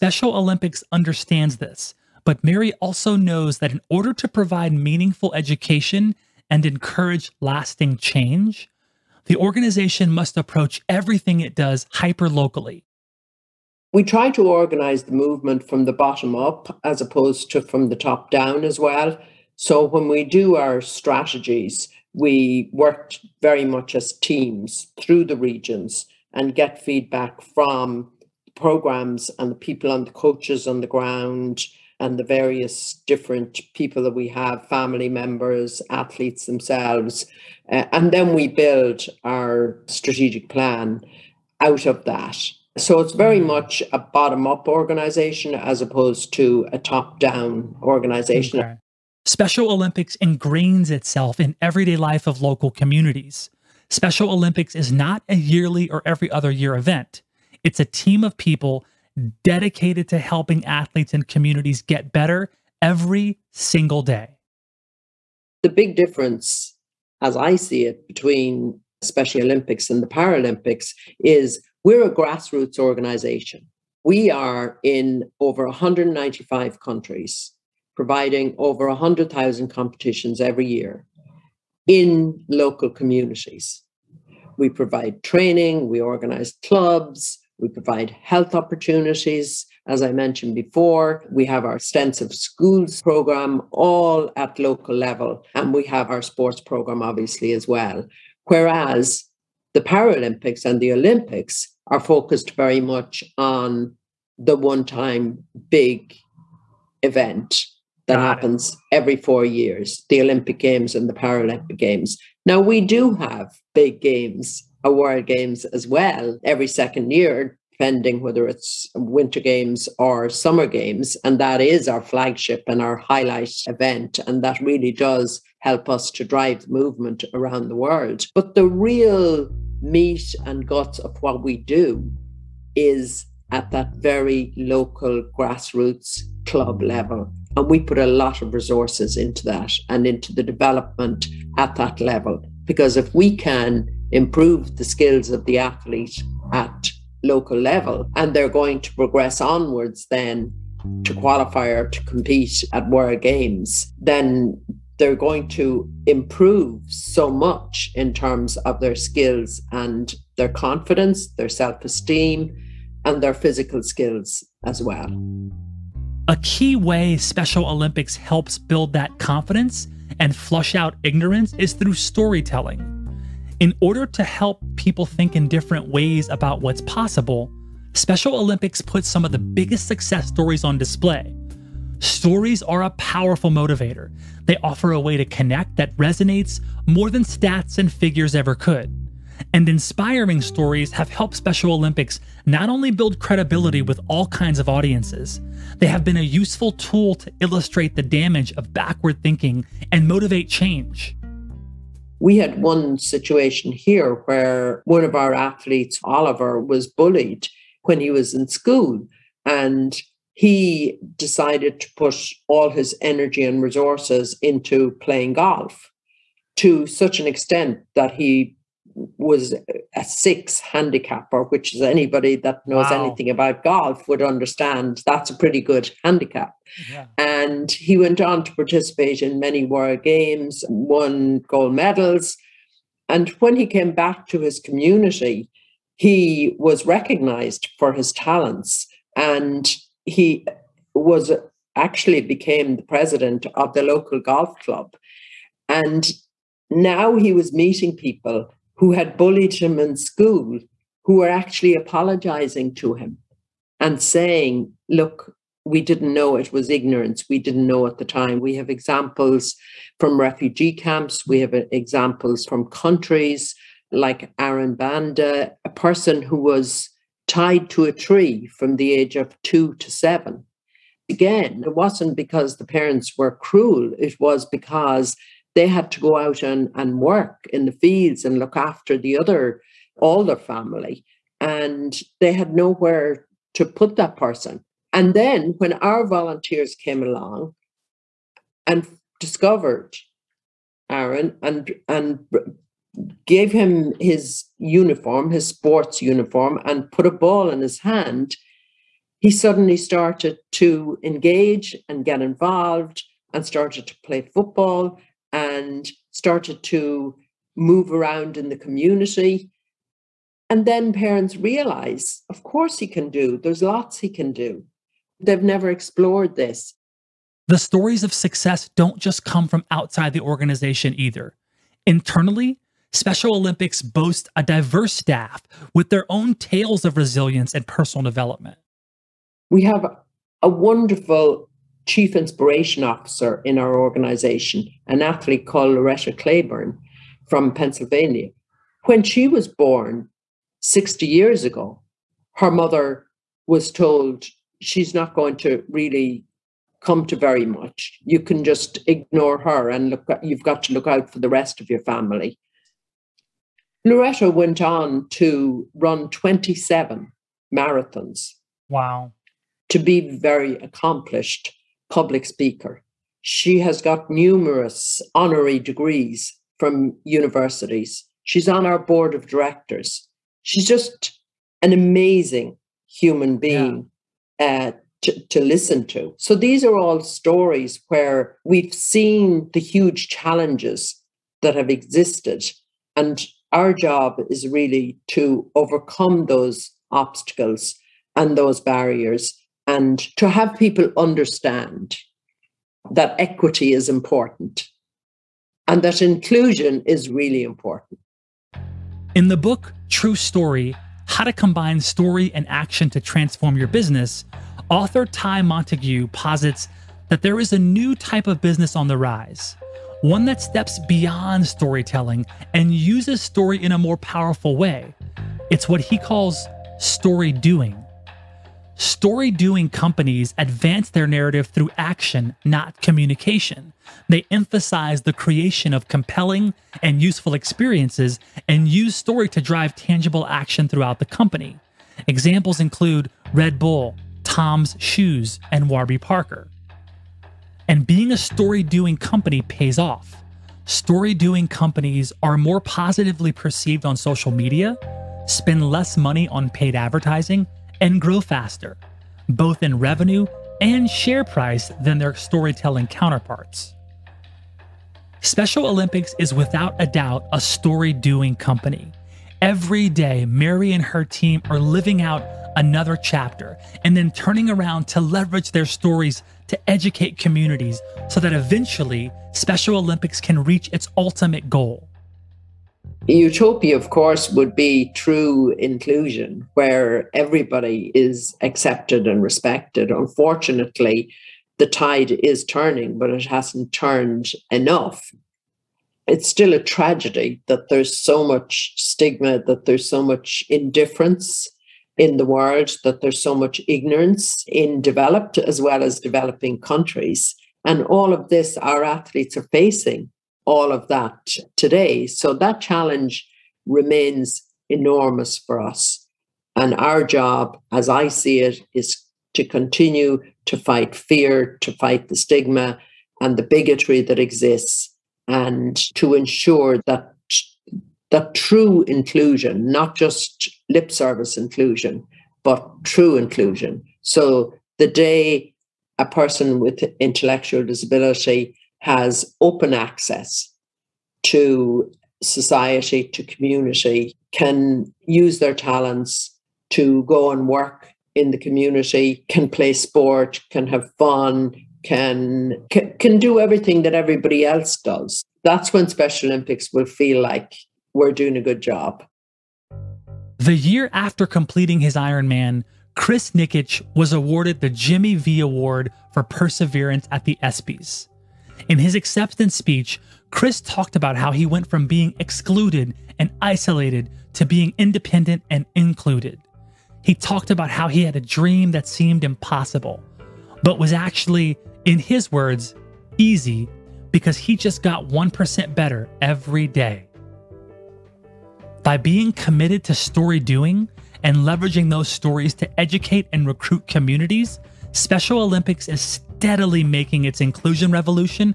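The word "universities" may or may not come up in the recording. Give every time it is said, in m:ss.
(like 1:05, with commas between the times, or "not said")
6:07.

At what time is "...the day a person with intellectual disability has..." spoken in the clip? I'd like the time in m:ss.
8:44.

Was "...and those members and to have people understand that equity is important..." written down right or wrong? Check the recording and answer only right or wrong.
wrong.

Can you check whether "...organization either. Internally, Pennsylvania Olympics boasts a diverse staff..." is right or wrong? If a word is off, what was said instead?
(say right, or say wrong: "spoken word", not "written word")
wrong: "Special", not "Pennsylvania".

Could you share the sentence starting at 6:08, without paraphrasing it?
She's on our board of directors.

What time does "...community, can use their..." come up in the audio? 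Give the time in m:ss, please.
8:53.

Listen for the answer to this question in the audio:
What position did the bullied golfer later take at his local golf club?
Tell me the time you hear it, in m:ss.
4:02.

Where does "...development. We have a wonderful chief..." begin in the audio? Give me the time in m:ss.
5:28.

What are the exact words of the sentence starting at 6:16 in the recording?
So these are all stories where we've seen the huge challenges that have existed.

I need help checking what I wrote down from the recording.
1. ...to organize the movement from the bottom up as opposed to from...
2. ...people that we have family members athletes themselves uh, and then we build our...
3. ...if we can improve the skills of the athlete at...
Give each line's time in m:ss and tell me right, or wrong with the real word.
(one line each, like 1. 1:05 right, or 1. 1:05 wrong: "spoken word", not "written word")
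1. 0:14 right
2. 0:33 right
3. 2:22 right.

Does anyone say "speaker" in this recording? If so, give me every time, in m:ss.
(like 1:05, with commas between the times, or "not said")
6:02.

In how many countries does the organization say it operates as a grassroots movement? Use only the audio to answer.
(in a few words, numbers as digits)
over 195.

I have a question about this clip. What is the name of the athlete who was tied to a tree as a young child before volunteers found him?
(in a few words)
Aaron Banda.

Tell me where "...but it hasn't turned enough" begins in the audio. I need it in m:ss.
8:02.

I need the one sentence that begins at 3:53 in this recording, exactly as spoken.
And when he came back to his community, he was recognized for his talents.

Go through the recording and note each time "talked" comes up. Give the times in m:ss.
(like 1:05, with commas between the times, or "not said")
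9:20, 9:27.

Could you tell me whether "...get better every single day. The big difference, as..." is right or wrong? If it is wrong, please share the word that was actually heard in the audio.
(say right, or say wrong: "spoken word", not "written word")
right.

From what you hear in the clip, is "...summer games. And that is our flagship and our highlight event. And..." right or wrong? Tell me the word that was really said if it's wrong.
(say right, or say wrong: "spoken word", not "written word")
right.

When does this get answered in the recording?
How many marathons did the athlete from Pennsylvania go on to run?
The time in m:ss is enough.
5:56.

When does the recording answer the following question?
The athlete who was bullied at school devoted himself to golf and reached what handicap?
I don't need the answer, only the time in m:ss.
3:40.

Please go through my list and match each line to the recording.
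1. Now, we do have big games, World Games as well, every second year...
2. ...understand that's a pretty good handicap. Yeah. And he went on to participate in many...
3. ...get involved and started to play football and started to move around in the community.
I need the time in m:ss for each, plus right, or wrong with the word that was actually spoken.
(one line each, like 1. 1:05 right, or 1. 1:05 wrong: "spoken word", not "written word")
1. 1:52 right
2. 3:44 right
3. 5:02 right.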